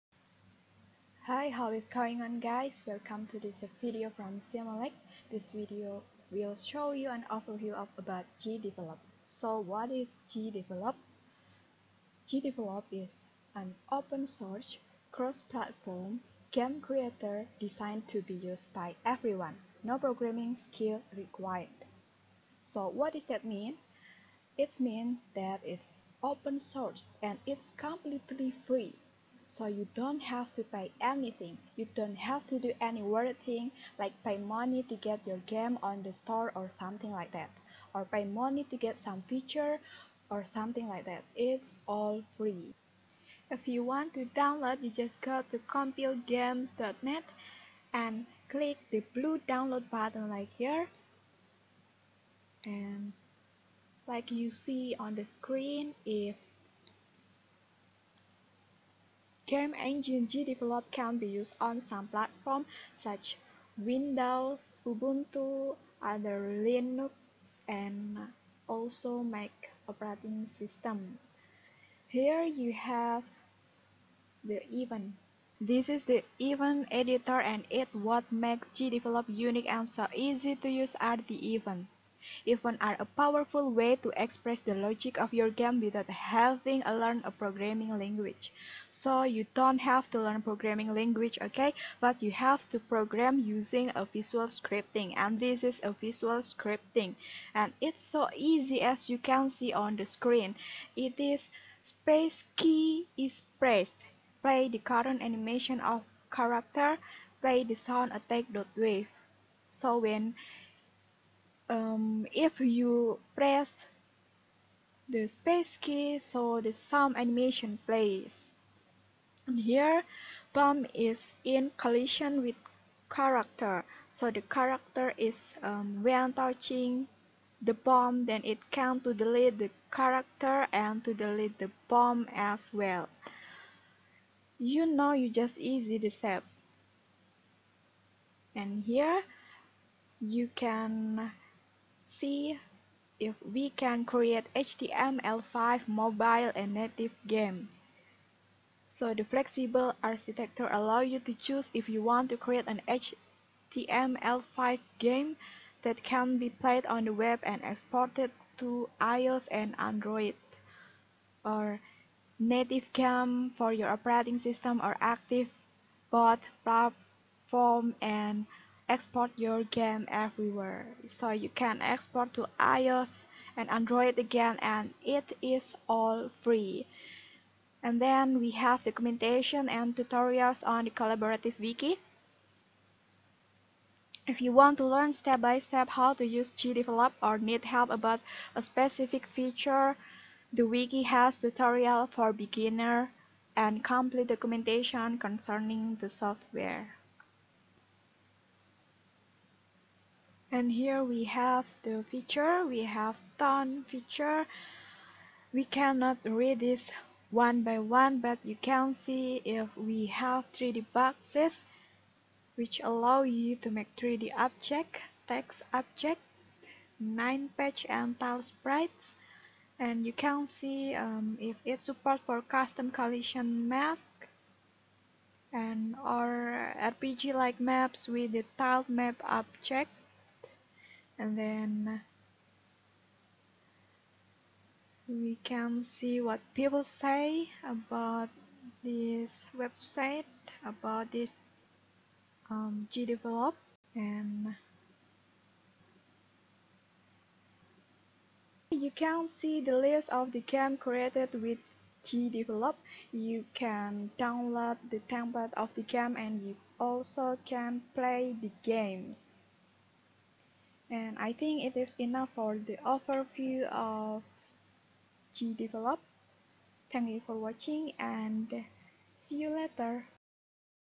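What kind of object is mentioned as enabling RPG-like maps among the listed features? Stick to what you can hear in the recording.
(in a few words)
Tiled map object.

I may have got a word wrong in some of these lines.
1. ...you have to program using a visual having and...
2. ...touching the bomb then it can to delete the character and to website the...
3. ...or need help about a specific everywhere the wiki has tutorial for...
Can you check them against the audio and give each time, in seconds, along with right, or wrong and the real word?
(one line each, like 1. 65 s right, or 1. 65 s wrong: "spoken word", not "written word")
1. 92 s wrong: "scripting", not "having"
2. 126 s wrong: "delete", not "website"
3. 187 s wrong: "feature", not "everywhere".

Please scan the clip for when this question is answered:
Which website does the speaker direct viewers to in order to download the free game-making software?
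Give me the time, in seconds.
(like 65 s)
45 s.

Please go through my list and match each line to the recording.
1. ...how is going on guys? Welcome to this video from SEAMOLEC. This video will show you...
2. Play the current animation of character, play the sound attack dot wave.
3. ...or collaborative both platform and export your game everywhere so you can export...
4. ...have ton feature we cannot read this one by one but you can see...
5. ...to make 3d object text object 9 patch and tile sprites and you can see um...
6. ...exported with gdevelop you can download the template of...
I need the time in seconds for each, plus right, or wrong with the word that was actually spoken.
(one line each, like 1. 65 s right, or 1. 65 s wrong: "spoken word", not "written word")
1. 1 s right
2. 104 s right
3. 164 s wrong: "active", not "collaborative"
4. 202 s right
5. 213 s right
6. 250 s wrong: "created", not "exported".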